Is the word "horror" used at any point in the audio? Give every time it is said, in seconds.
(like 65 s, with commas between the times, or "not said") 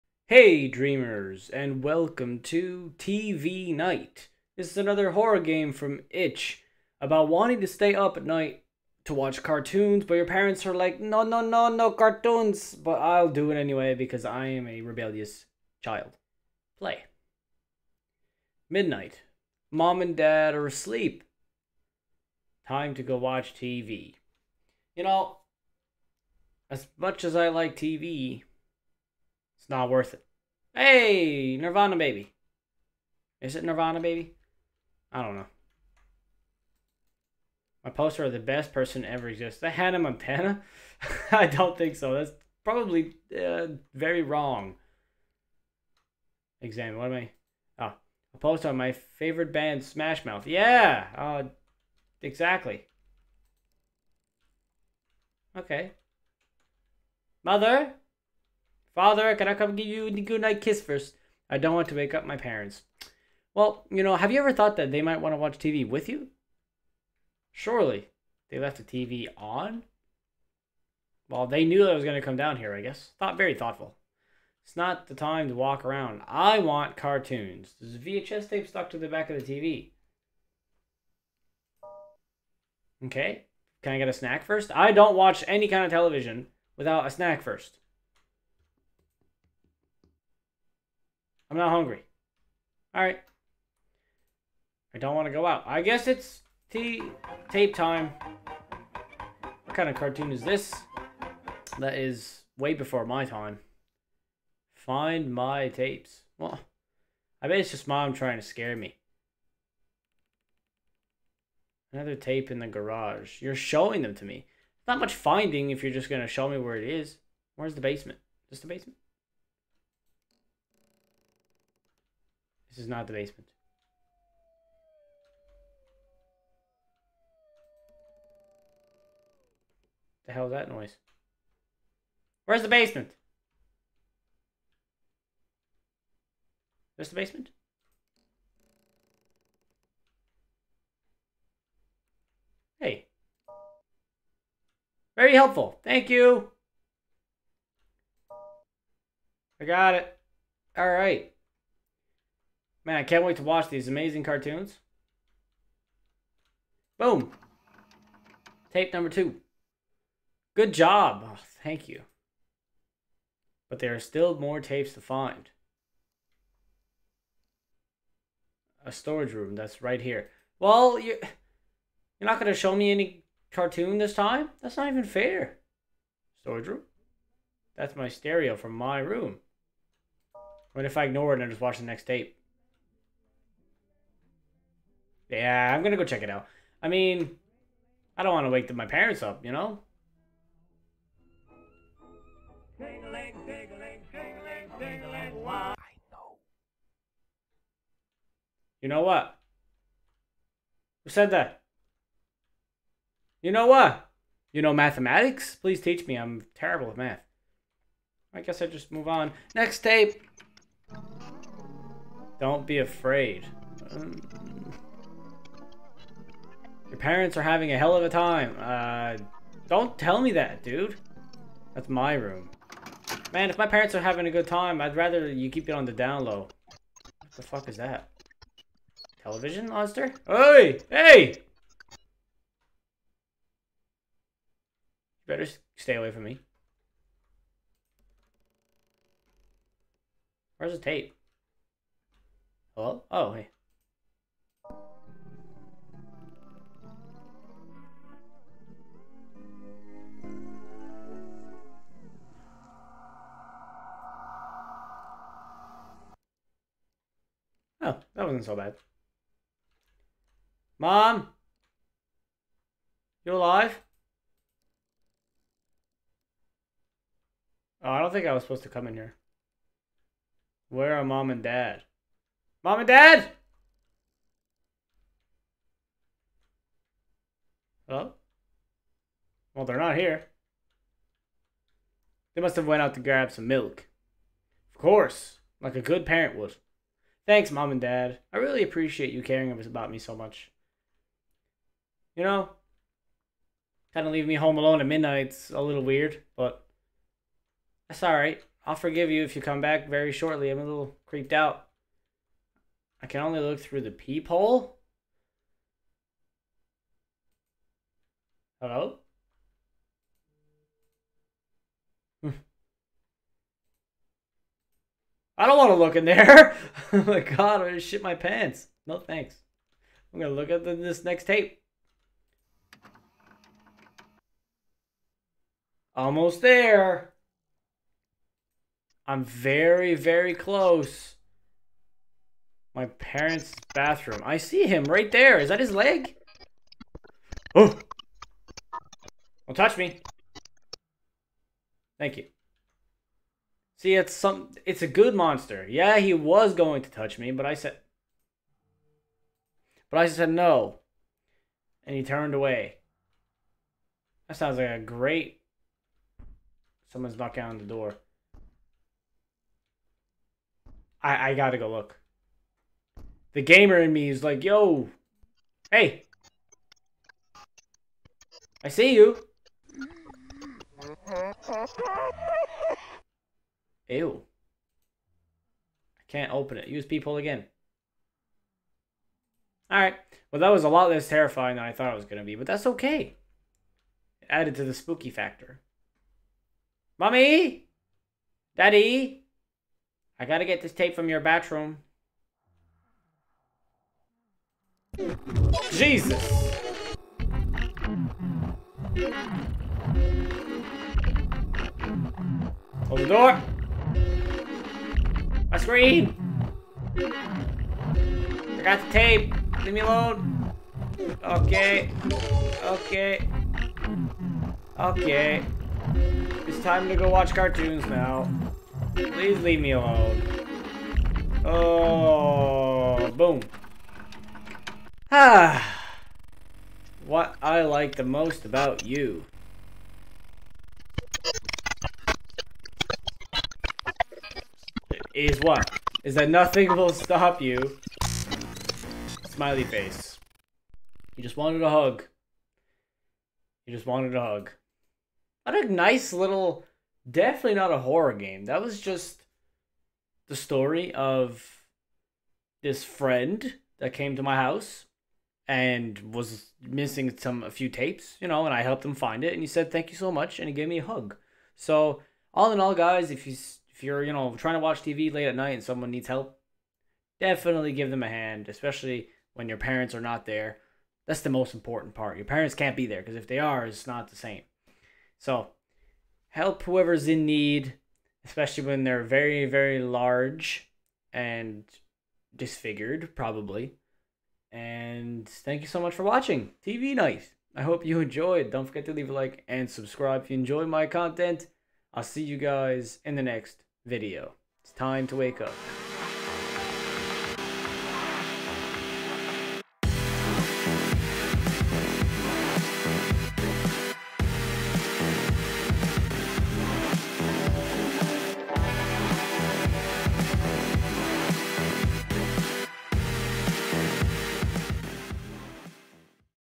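5 s, 447 s.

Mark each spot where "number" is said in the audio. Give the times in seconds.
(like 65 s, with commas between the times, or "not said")
158 s.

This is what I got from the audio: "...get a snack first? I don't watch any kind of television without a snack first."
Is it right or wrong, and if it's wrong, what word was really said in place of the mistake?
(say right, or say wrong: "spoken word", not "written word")
right.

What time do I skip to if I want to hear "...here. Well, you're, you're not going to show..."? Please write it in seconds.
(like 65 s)
170 s.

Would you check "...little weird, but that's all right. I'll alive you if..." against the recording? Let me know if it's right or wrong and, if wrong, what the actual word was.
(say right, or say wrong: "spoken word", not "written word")
wrong: "forgive", not "alive".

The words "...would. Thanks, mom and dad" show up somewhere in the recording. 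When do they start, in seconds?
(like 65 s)
286 s.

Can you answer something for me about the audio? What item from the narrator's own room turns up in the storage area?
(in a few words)
Stereo.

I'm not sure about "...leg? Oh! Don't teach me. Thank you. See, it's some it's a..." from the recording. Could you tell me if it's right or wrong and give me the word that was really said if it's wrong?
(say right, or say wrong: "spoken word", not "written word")
wrong: "touch", not "teach".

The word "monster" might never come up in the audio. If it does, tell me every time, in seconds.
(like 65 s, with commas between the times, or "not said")
229 s, 345 s.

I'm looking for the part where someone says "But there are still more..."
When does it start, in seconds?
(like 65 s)
163 s.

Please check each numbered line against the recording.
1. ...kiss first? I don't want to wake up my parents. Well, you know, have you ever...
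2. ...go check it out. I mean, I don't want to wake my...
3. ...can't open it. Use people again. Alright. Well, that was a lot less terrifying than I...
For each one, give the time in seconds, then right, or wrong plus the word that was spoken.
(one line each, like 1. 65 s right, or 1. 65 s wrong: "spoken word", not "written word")
1. 60 s right
2. 185 s right
3. 376 s right.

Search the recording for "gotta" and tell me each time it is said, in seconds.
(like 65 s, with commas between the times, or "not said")
361 s, 390 s.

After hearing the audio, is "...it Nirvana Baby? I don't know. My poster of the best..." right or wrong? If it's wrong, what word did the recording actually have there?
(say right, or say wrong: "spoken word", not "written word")
right.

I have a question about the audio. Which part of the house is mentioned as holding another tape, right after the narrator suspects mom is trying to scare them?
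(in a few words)
The garage.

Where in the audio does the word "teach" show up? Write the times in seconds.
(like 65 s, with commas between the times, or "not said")
205 s.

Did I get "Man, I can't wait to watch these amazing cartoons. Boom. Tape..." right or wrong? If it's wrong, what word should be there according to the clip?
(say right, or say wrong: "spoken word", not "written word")
right.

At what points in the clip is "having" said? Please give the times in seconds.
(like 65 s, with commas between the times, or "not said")
217 s, 224 s.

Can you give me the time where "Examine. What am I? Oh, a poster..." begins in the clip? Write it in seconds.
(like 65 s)
46 s.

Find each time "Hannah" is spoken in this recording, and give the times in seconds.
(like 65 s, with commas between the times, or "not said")
39 s.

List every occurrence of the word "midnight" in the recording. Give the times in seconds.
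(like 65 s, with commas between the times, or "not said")
18 s, 294 s.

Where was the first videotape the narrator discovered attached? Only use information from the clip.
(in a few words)
Back of the TV.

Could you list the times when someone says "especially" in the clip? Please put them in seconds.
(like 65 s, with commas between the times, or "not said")
468 s, 478 s.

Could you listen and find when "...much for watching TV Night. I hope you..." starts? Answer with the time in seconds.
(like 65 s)
485 s.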